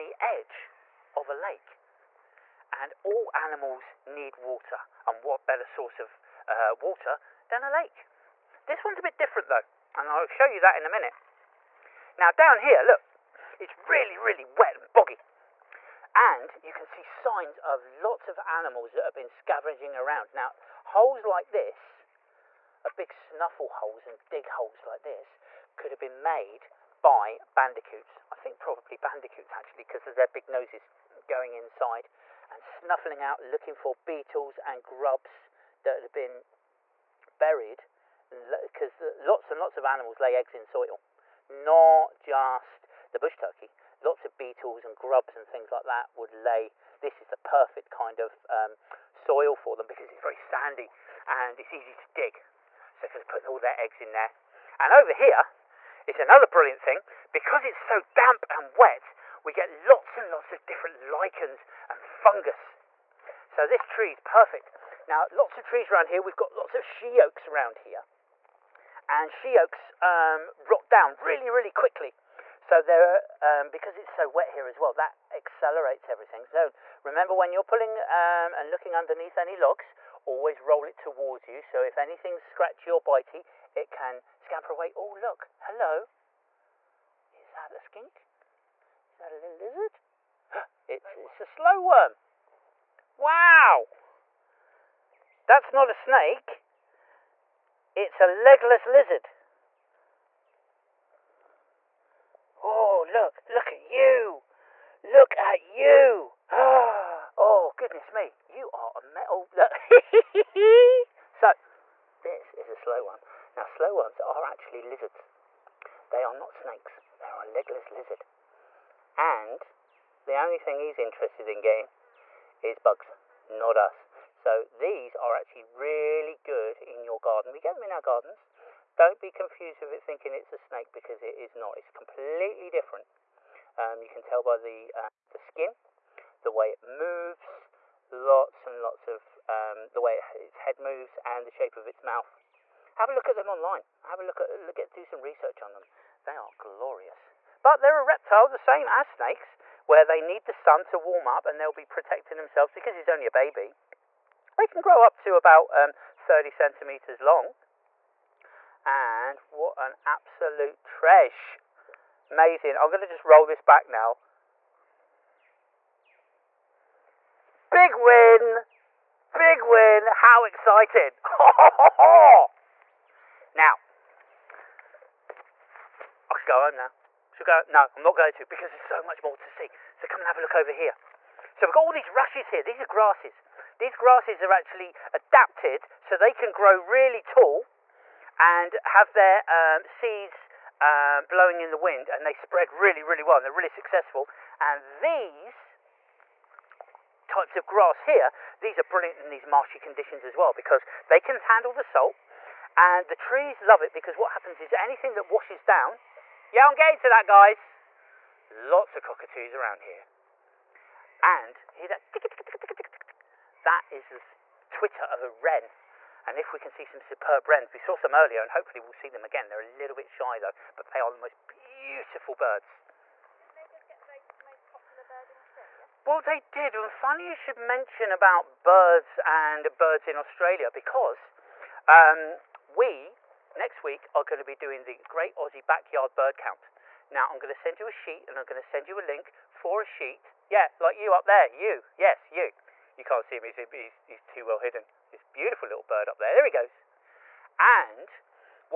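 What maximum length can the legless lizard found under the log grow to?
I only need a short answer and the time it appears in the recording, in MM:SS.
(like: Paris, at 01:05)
30 centimeters, at 02:36.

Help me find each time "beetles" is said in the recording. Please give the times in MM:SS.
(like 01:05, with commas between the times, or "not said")
00:34, 00:44.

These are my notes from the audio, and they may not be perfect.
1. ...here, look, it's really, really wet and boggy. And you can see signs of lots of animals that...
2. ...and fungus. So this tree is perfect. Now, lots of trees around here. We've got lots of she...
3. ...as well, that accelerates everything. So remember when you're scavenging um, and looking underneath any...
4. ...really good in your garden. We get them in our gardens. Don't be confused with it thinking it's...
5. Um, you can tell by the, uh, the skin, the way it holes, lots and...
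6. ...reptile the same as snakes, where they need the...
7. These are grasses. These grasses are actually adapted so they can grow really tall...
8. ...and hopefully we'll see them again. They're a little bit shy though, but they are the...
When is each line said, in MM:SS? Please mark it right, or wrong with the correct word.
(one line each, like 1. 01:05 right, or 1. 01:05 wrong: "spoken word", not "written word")
1. 00:12 right
2. 01:01 right
3. 01:14 wrong: "pulling", not "scavenging"
4. 02:05 right
5. 02:13 wrong: "moves", not "holes"
6. 02:28 right
7. 03:02 right
8. 03:38 right.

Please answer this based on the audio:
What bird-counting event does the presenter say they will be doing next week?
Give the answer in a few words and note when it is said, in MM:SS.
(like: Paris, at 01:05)
Great Aussie Backyard Bird Count, at 03:55.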